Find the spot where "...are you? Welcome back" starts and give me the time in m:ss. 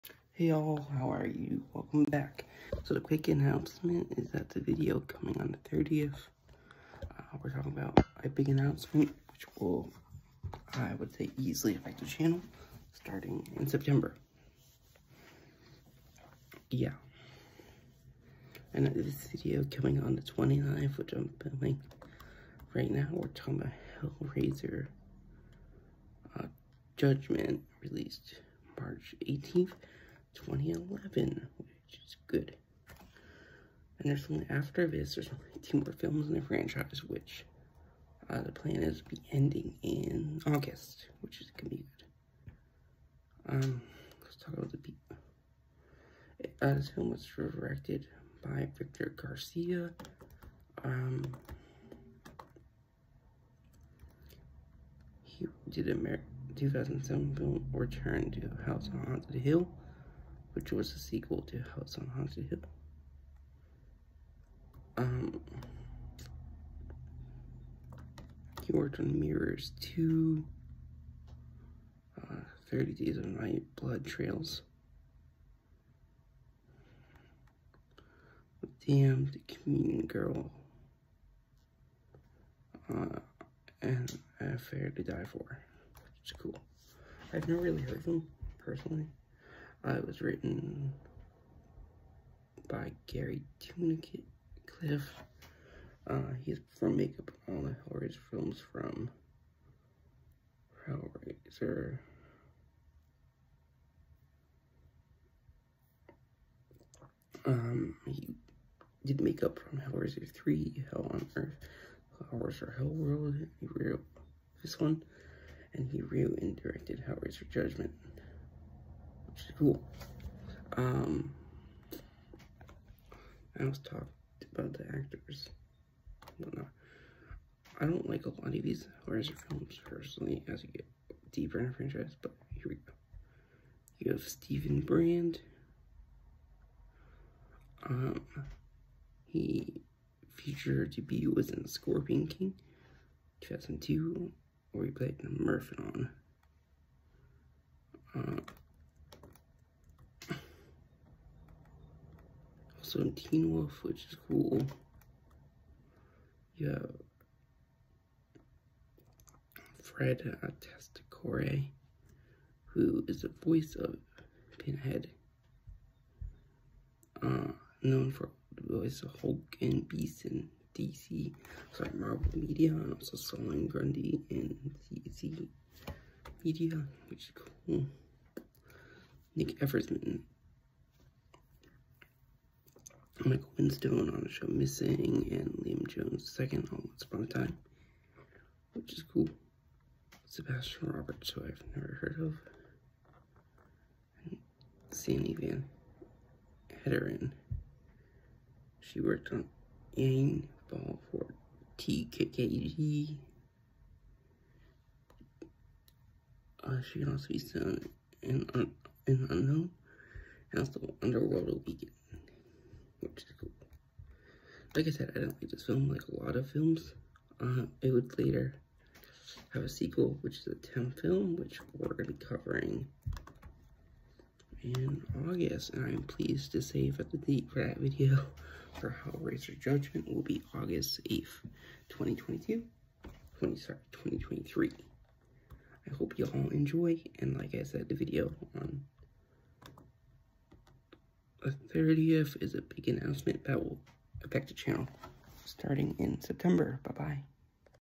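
0:01.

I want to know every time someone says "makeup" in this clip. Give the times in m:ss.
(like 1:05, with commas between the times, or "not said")
1:36, 1:49.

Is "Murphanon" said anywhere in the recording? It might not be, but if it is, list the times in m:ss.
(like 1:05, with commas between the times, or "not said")
2:25.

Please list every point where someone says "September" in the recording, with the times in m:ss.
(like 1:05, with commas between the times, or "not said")
0:13, 4:06.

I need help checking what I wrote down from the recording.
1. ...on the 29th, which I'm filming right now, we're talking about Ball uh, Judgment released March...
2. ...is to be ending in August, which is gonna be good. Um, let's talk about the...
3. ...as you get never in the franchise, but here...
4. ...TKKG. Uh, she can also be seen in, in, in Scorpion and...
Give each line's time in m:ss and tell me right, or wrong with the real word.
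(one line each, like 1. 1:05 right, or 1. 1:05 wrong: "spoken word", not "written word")
1. 0:20 wrong: "Hellraiser", not "Ball"
2. 0:38 right
3. 2:10 wrong: "deeper", not "never"
4. 3:21 wrong: "Unknown", not "Scorpion".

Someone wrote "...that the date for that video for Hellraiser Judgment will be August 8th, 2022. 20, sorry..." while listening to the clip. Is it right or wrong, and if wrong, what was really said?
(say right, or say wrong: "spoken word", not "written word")
right.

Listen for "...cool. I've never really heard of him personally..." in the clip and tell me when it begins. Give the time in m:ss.
1:26.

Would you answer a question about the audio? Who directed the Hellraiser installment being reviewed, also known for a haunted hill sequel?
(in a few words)
Victor Garcia.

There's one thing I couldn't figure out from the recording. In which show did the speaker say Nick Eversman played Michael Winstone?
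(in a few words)
Missing.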